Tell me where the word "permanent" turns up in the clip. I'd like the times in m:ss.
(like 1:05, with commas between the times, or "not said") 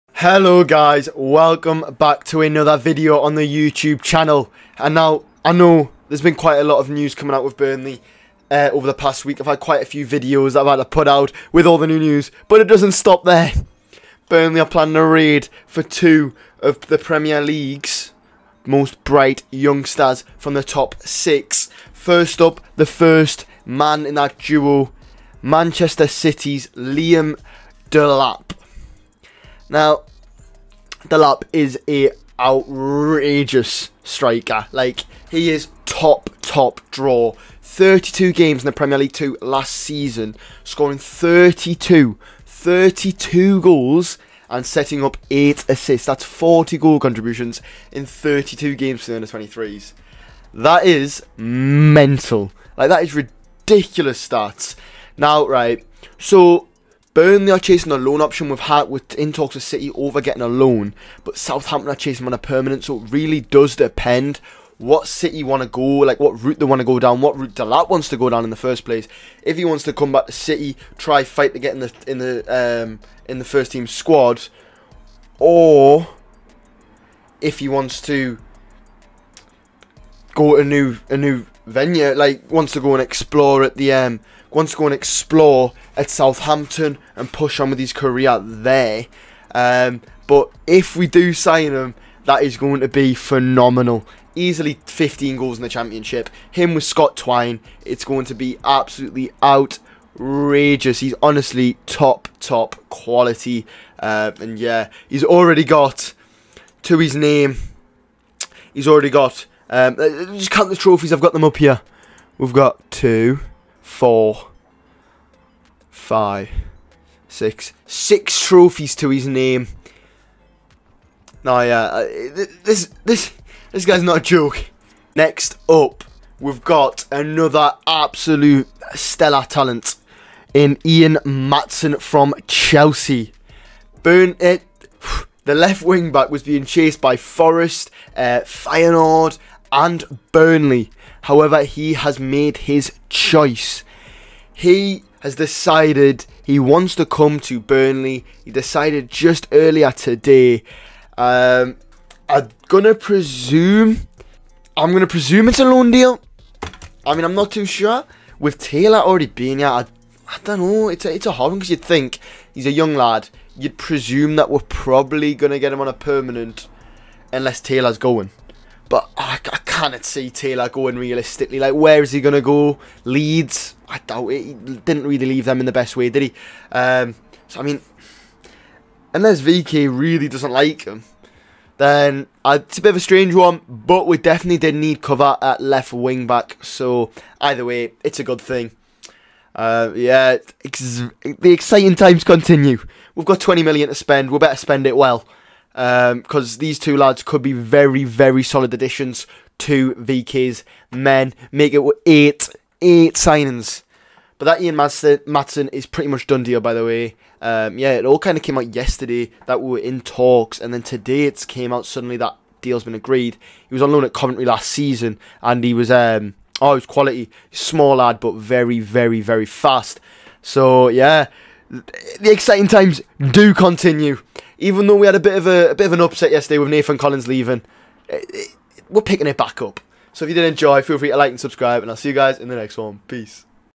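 1:02, 2:45.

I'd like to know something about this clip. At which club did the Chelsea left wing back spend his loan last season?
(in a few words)
Coventry.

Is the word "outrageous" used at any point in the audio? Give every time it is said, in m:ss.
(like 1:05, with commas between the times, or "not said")
0:32, 1:39.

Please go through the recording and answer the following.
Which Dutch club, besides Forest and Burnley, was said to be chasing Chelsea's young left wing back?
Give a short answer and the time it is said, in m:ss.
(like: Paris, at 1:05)
Feyenoord, at 2:18.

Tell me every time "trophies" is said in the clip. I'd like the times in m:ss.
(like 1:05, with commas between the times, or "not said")
1:50, 1:58.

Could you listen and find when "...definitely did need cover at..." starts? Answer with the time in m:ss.
3:04.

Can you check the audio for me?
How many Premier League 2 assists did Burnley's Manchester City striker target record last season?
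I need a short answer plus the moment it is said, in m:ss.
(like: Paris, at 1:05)
8, at 0:45.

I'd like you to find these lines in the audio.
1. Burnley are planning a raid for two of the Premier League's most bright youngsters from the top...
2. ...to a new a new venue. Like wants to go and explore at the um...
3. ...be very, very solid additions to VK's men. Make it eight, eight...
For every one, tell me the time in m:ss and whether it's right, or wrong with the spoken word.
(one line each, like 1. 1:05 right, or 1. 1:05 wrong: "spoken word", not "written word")
1. 0:14 right
2. 1:20 right
3. 3:17 right.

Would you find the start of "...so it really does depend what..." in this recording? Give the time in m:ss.
1:02.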